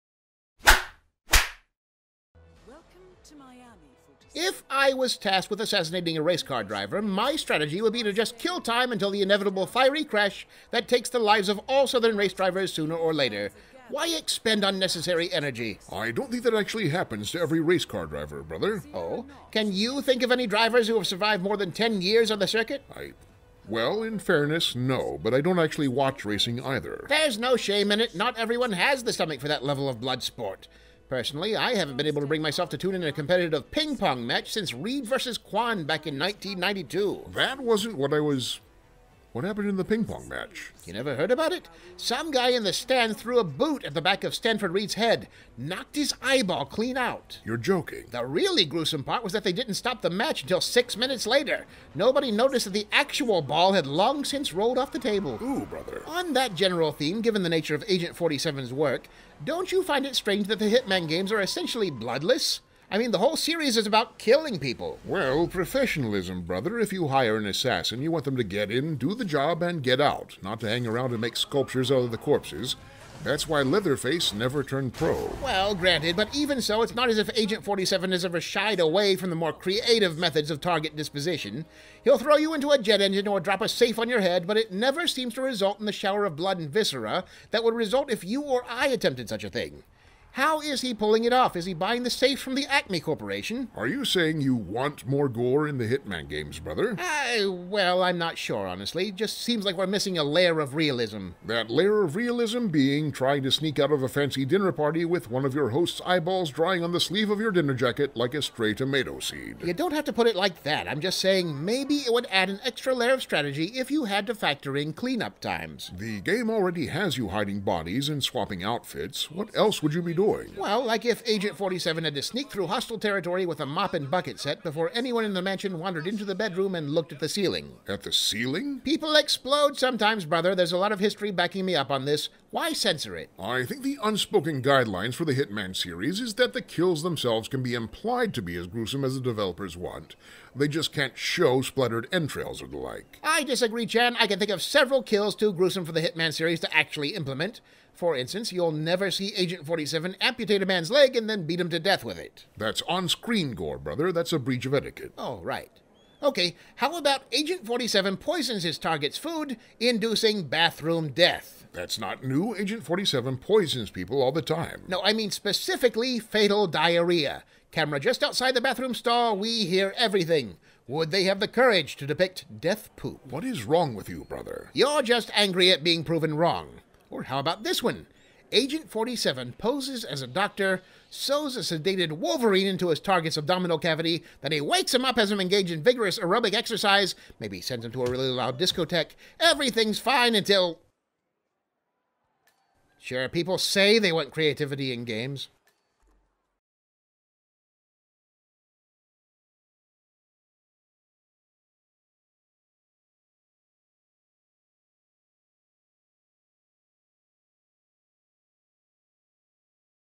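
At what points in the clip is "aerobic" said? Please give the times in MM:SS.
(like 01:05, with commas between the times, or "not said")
03:06.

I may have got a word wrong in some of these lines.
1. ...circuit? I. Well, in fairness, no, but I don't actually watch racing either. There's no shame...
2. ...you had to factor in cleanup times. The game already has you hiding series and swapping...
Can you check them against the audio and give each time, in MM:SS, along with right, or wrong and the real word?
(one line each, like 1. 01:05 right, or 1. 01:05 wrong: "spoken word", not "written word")
1. 00:22 right
2. 01:53 wrong: "bodies", not "series".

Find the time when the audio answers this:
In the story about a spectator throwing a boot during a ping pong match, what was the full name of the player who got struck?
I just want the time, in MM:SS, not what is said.
00:44.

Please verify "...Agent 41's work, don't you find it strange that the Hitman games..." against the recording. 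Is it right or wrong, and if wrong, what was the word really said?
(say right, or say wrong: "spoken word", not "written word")
wrong: "47", not "41".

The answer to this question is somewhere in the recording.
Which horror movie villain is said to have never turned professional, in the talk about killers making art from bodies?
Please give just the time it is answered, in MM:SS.
01:13.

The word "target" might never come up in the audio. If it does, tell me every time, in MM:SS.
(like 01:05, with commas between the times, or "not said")
01:20, 02:38, 03:02.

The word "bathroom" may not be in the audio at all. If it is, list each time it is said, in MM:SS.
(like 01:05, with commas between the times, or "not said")
02:40, 02:48.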